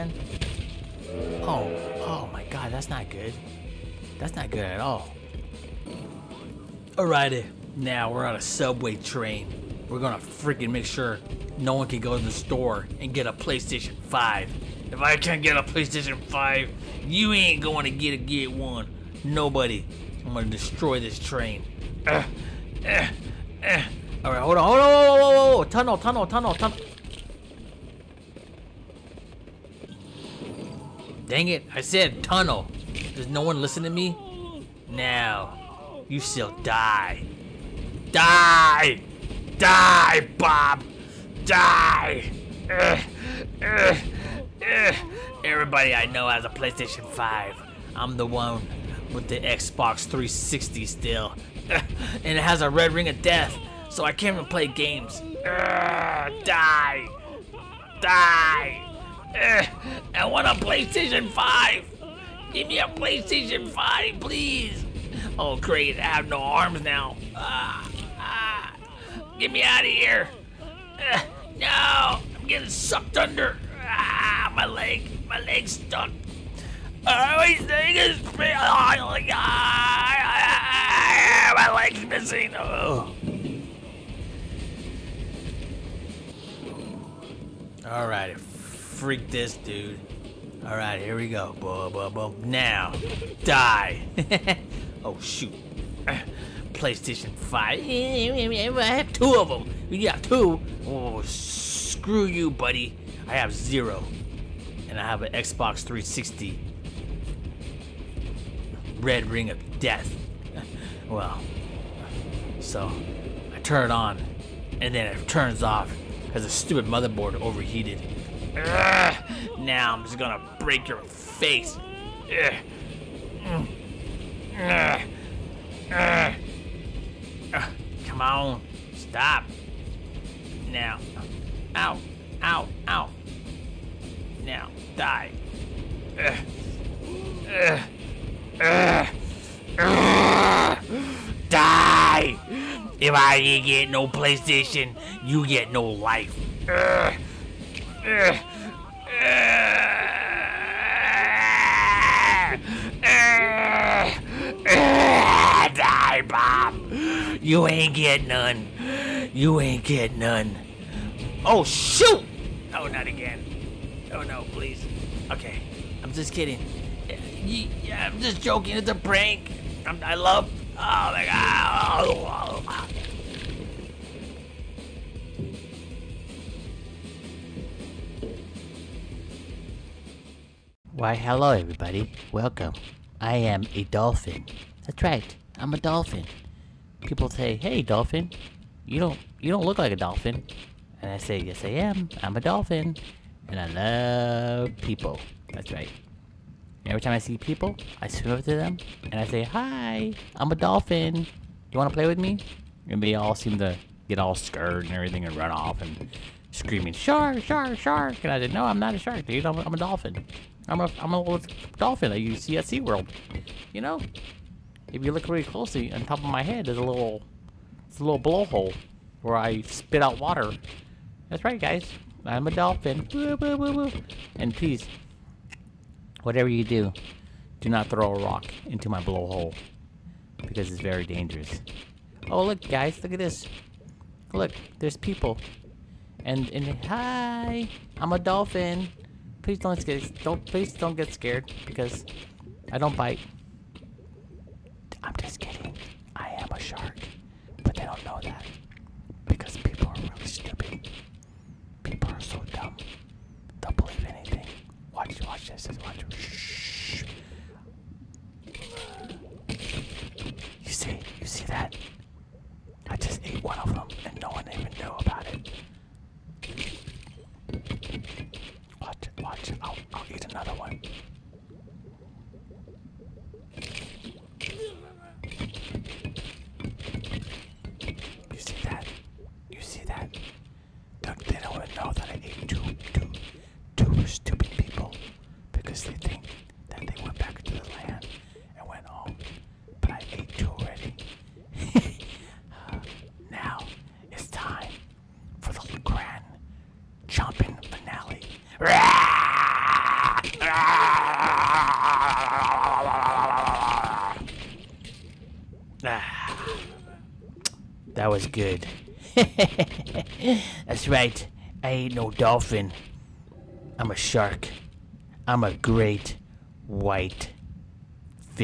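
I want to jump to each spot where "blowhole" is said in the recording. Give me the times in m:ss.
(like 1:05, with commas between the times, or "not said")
3:38, 3:49.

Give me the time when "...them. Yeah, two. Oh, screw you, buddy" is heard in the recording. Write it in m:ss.
1:39.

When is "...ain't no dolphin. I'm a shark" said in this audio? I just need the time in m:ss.
5:11.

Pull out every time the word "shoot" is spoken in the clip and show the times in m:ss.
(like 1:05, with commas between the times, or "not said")
1:35, 2:41.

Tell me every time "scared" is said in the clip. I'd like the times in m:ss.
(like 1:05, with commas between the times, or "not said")
3:24, 4:01.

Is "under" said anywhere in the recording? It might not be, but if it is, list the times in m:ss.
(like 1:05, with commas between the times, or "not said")
1:13.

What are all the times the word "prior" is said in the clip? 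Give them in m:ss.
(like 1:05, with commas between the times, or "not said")
not said.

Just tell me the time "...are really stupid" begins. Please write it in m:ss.
4:09.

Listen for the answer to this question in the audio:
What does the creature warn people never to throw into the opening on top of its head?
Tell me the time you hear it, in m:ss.
3:48.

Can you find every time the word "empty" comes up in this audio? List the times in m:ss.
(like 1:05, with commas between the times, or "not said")
not said.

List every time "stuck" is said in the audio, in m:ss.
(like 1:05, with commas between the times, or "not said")
1:15.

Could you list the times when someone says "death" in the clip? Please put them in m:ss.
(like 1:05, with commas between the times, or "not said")
0:53, 1:49.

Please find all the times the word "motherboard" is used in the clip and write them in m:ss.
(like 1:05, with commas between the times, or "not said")
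1:56.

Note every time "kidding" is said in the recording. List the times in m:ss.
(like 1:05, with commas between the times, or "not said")
2:46, 4:05.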